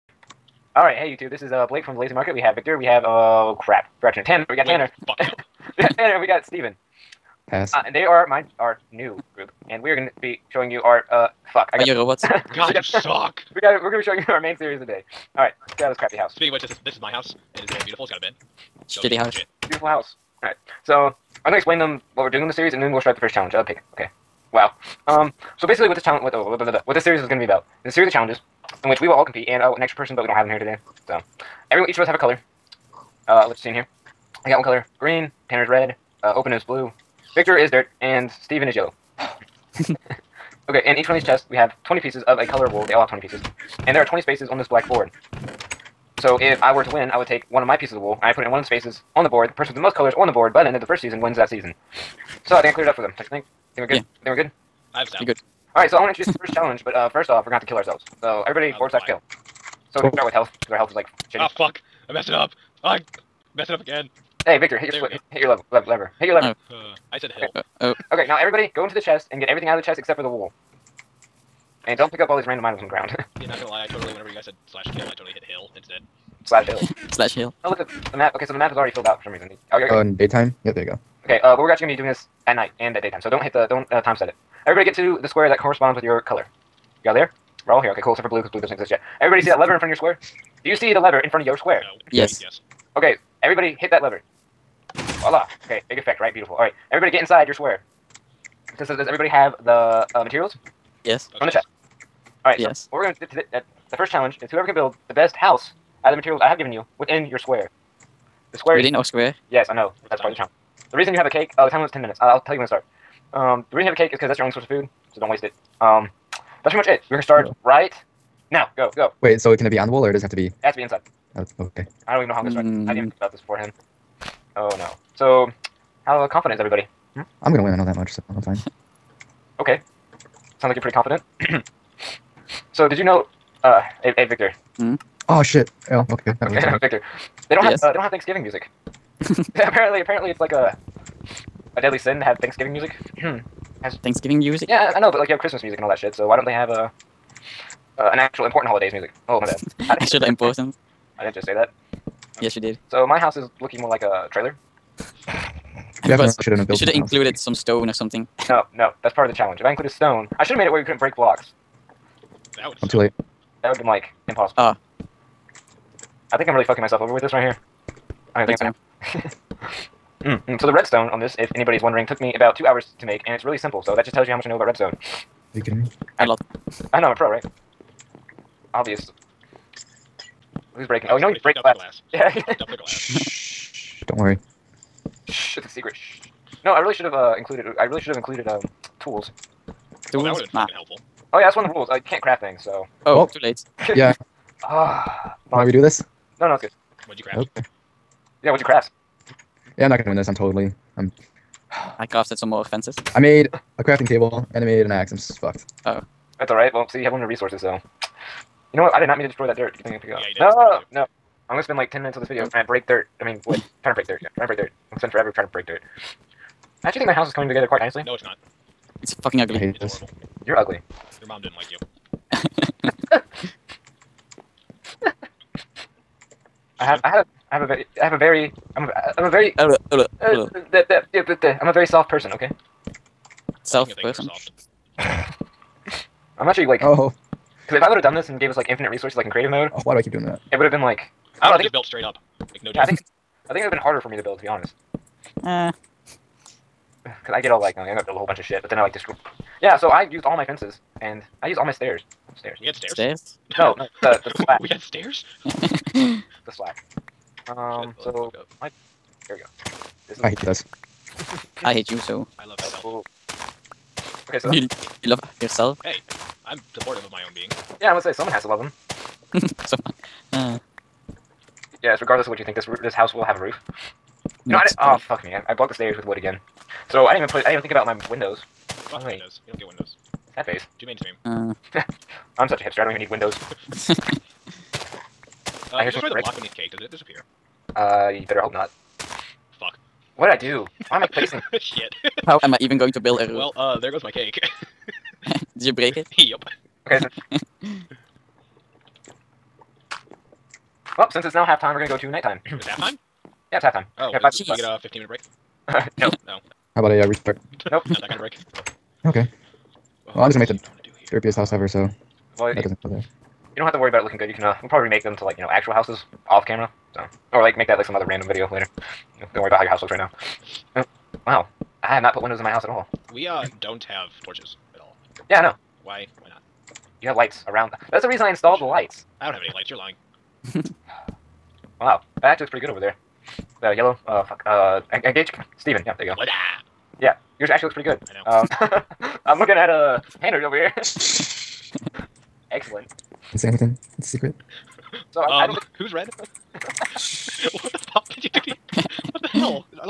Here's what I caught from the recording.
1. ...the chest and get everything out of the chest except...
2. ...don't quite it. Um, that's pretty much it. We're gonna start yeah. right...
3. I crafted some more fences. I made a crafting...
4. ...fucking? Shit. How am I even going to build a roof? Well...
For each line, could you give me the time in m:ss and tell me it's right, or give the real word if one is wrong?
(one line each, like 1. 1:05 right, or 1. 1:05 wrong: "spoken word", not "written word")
1. 1:08 right
2. 1:55 wrong: "waste", not "quite"
3. 3:21 right
4. 4:51 wrong: "placing", not "fucking".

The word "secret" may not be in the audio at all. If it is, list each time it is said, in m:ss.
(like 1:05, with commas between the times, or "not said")
3:05, 5:44.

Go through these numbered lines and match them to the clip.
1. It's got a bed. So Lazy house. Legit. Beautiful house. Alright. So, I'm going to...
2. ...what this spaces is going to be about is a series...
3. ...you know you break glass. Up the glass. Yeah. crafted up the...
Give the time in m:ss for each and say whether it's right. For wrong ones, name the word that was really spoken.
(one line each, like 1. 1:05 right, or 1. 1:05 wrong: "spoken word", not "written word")
1. 0:18 wrong: "Shitty", not "Lazy"
2. 0:26 wrong: "series", not "spaces"
3. 3:01 wrong: "fucked", not "crafted".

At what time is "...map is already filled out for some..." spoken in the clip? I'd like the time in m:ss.
1:18.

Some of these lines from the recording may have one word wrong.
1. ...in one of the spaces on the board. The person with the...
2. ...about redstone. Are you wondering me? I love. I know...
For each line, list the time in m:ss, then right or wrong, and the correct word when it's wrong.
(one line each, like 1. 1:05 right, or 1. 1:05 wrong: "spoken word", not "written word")
1. 0:48 right
2. 2:54 wrong: "kidding", not "wondering".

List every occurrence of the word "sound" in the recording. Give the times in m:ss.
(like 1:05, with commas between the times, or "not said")
0:55, 2:10.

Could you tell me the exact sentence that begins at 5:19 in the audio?
You know, don't worry about how your house looks right now.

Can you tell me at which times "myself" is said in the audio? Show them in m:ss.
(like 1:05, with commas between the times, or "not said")
2:46, 4:22.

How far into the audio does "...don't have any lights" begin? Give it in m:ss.
5:29.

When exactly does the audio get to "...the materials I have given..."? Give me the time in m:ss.
1:46.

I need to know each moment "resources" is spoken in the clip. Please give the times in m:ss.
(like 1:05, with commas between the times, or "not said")
3:27, 3:58.